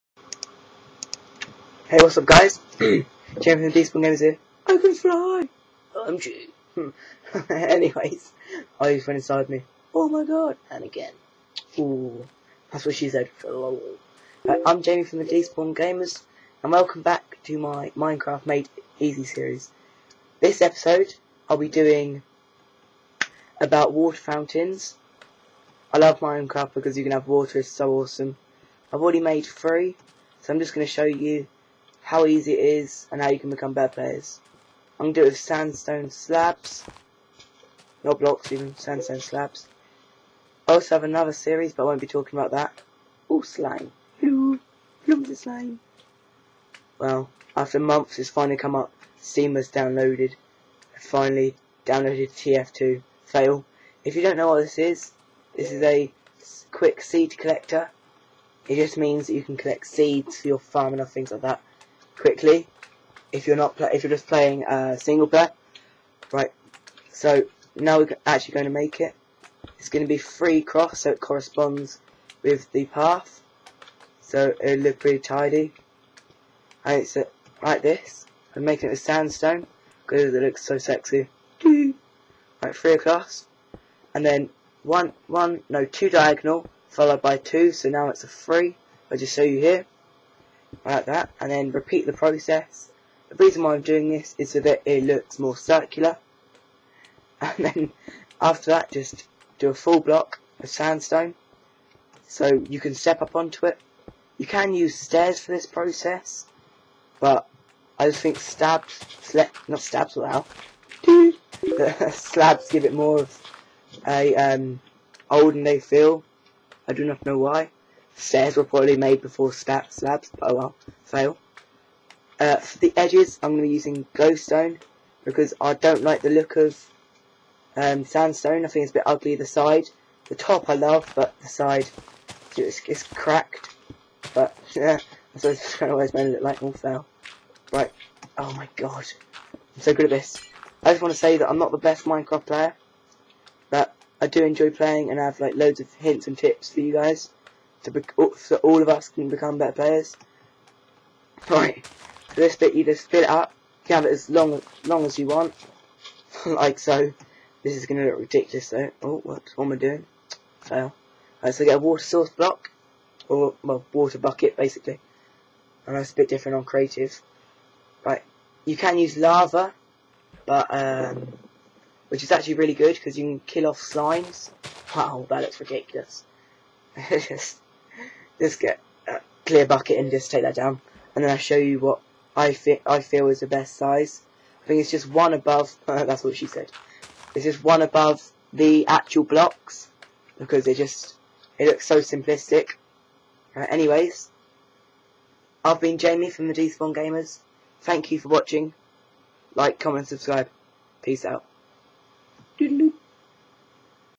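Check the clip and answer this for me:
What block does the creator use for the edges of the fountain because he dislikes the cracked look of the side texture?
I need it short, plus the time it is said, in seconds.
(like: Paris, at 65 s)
glowstone, at 124 s.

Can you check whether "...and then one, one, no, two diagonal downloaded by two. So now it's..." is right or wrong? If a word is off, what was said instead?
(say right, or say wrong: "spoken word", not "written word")
wrong: "followed", not "downloaded".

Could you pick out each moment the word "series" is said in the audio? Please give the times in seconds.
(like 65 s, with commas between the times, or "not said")
19 s, 41 s.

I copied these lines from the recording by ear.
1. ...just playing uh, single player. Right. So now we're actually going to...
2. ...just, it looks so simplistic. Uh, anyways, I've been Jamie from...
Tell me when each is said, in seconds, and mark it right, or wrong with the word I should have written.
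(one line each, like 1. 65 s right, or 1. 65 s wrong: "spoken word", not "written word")
1. 64 s right
2. 190 s right.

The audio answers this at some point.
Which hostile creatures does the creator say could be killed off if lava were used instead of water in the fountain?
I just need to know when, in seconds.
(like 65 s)
173 s.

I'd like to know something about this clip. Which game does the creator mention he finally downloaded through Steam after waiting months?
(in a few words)
TF2.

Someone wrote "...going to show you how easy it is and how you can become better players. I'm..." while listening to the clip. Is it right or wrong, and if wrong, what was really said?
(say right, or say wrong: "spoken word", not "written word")
right.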